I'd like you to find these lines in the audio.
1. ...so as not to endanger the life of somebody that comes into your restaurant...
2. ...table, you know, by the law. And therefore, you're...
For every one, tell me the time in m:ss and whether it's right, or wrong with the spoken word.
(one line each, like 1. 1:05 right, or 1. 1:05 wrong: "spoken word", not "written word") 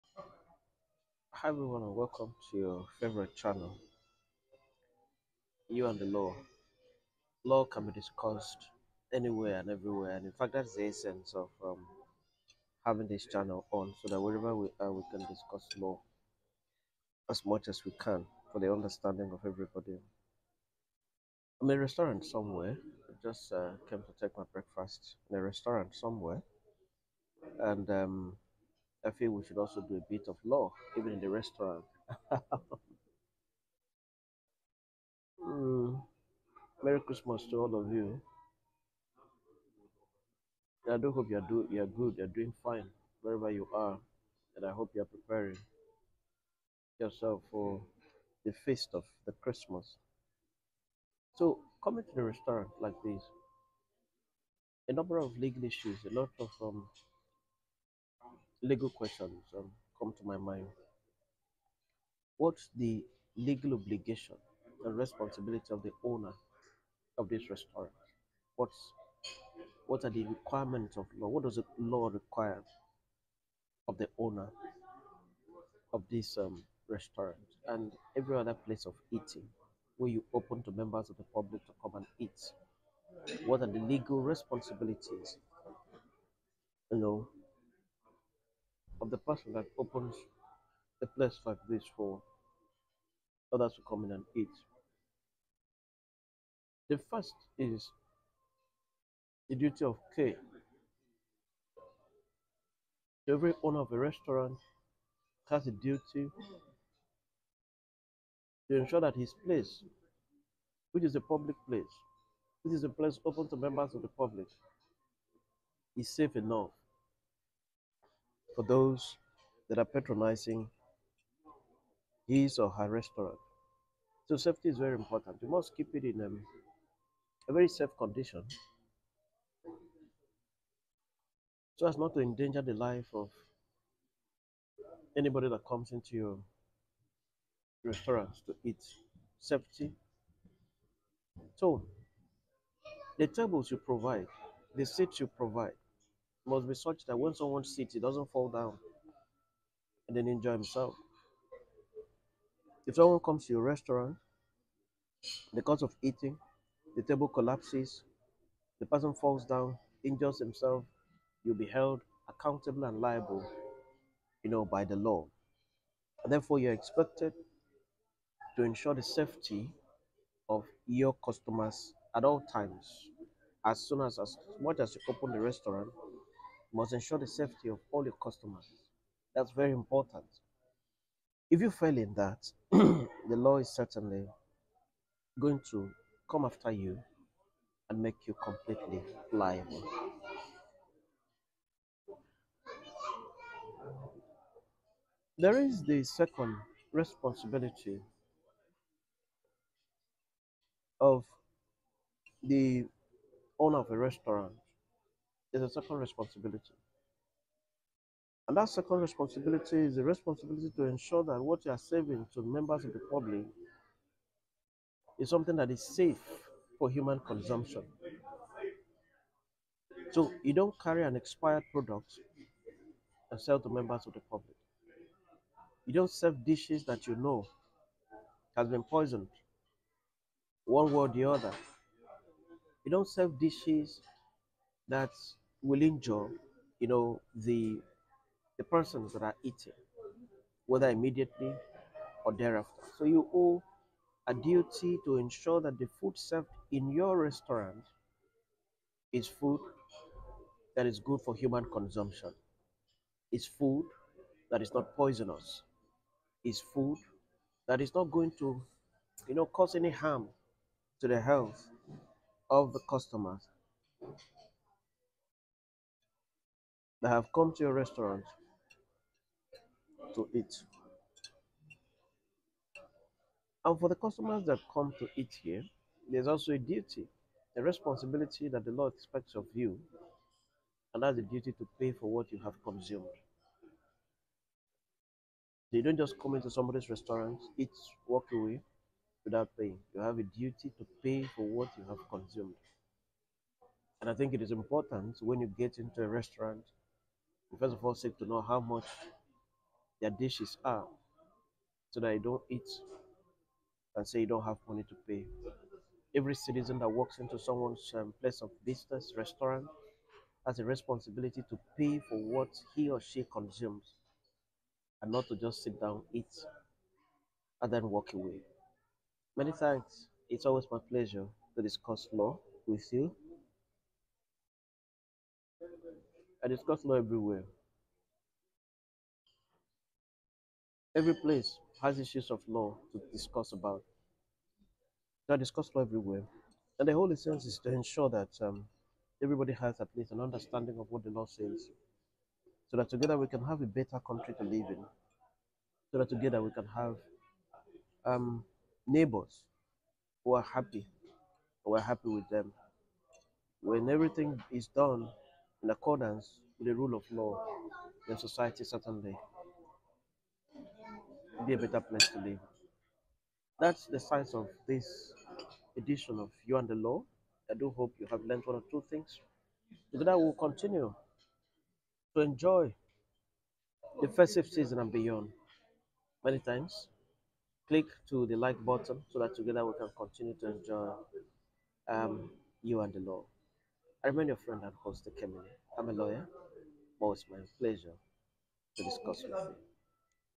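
1. 2:11 wrong: "anybody", not "somebody"
2. 2:42 wrong: "liable", not "table".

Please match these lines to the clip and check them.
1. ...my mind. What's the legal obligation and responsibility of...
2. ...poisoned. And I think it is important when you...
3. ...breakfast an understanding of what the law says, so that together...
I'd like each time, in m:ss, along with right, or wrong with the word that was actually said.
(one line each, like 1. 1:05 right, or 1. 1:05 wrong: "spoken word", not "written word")
1. 1:00 right
2. 4:52 wrong: "consumed", not "poisoned"
3. 5:39 wrong: "least", not "breakfast".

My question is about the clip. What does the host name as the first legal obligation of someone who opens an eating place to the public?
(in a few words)
Duty of care.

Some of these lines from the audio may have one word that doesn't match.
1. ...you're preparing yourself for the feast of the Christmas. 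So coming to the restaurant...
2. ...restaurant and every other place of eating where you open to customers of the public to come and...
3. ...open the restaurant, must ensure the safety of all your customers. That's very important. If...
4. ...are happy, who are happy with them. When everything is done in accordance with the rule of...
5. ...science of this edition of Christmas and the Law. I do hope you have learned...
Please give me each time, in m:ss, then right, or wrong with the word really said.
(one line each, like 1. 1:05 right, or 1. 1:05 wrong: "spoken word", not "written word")
1. 0:44 right
2. 1:16 wrong: "members", not "customers"
3. 2:55 right
4. 5:50 right
5. 6:03 wrong: "You", not "Christmas".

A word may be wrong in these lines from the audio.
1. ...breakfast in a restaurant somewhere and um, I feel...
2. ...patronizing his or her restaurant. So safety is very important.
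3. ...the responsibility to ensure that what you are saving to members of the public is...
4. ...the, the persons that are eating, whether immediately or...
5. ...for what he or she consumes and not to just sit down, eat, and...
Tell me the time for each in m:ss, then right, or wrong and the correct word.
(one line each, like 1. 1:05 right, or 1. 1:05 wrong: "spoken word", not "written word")
1. 0:24 right
2. 1:59 right
3. 3:29 right
4. 3:57 right
5. 5:12 right.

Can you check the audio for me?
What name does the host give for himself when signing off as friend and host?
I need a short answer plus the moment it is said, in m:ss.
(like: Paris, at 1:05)
Kemini, at 6:25.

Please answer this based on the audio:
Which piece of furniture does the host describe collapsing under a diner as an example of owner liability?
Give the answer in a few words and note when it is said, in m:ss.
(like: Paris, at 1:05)
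The table, at 2:36.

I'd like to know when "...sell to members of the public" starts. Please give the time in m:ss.
3:43.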